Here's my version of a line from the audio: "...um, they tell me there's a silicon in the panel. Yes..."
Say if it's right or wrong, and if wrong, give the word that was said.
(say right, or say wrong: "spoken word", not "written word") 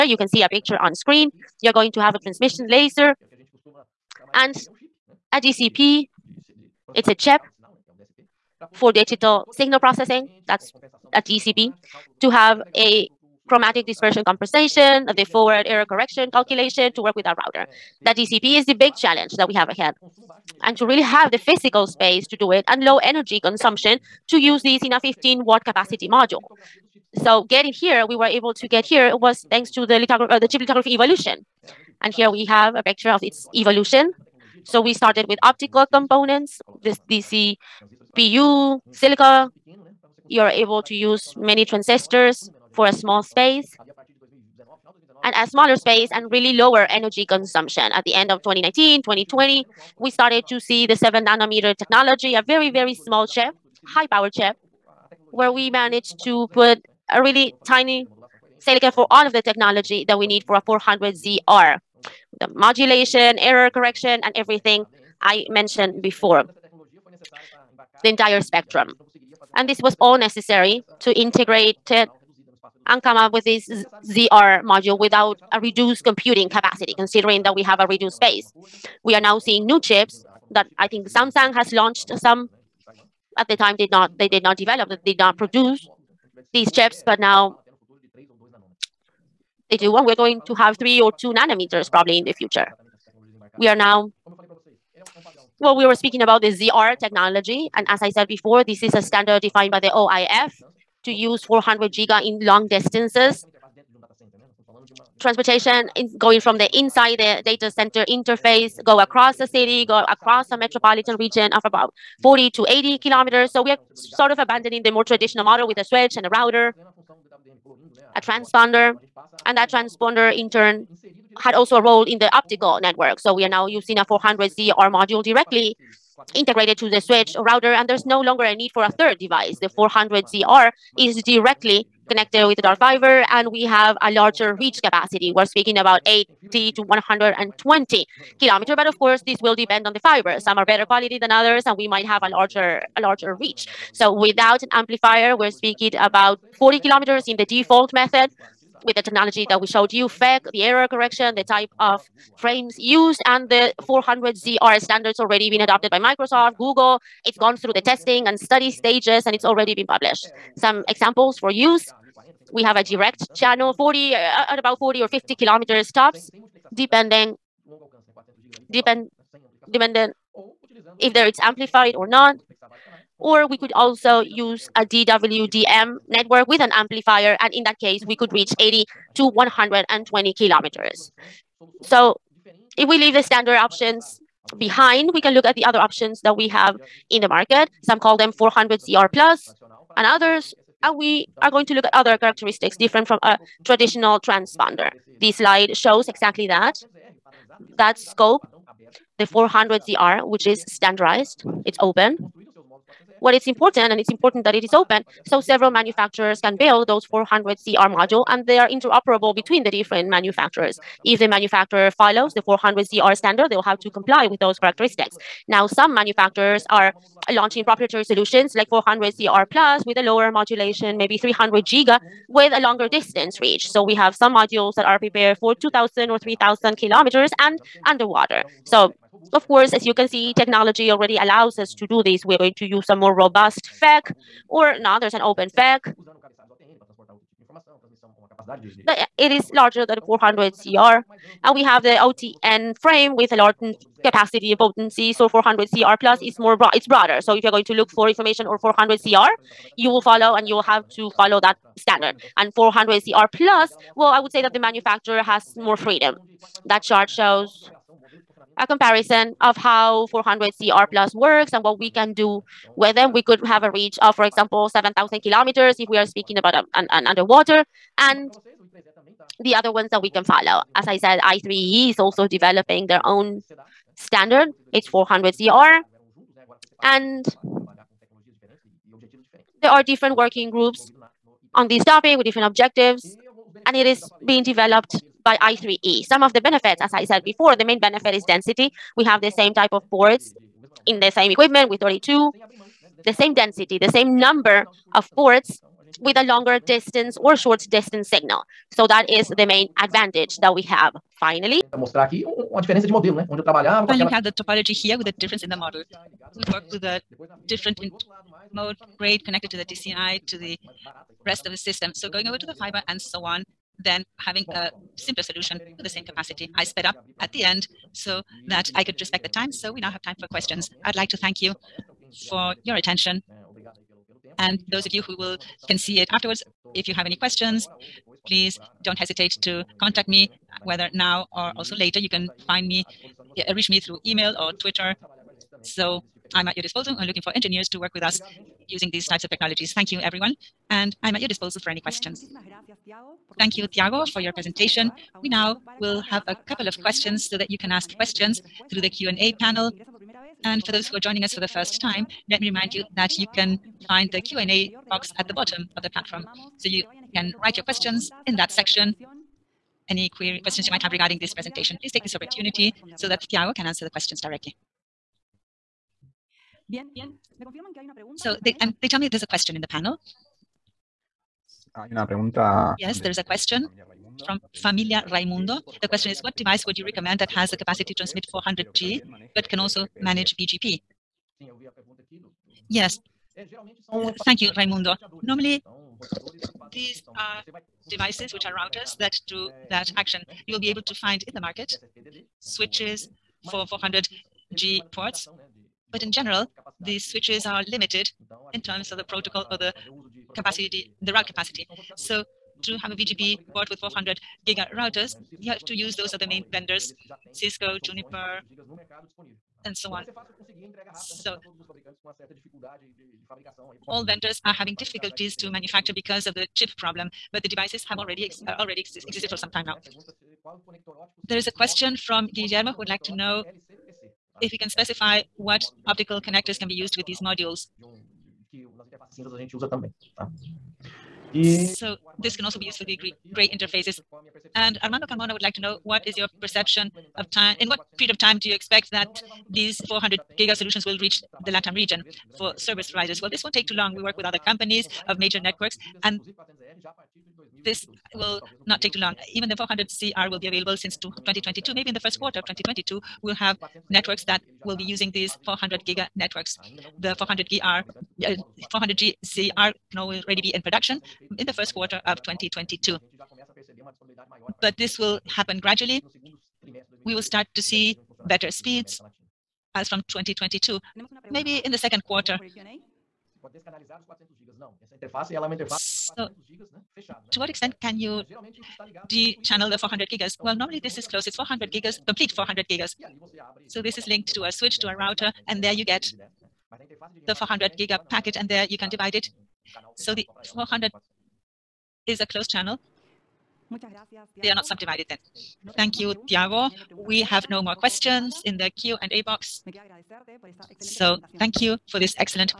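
wrong: "question", not "silicon".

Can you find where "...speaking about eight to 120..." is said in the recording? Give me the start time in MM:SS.
02:15.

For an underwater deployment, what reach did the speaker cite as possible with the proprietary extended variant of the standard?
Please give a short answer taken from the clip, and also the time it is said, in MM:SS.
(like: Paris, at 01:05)
7,000 kilometers, at 04:24.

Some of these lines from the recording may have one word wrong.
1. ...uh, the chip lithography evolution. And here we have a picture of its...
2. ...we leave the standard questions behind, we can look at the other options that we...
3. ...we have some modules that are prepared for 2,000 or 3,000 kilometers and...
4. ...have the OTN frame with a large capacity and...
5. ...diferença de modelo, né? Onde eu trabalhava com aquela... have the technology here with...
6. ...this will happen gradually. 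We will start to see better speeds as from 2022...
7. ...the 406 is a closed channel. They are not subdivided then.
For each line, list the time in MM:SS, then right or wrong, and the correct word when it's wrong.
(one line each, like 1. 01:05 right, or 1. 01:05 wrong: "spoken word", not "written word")
1. 00:30 right
2. 03:02 wrong: "options", not "questions"
3. 03:43 right
4. 04:01 right
5. 05:02 wrong: "topology", not "technology"
6. 07:44 right
7. 08:10 wrong: "400", not "406".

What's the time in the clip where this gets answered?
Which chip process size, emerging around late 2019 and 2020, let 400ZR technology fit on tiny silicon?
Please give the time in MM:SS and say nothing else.
00:50.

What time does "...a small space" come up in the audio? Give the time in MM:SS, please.
00:42.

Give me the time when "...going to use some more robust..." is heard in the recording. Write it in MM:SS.
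03:52.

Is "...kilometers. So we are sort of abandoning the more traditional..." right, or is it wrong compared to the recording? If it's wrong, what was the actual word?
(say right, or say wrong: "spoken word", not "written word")
right.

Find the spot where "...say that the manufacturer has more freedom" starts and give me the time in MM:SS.
04:14.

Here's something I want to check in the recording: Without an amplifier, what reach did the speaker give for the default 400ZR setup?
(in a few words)
40 kilometers.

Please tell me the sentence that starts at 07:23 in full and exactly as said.
Well, this won't take too long.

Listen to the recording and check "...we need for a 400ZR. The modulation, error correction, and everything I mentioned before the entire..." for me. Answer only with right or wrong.
right.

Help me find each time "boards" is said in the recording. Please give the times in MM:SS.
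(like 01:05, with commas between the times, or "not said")
04:49, 04:55.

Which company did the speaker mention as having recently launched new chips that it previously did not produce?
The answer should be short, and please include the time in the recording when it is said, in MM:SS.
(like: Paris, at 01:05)
Samsung, at 01:21.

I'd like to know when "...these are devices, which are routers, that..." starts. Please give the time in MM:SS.
06:26.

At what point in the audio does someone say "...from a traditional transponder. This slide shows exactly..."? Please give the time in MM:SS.
03:13.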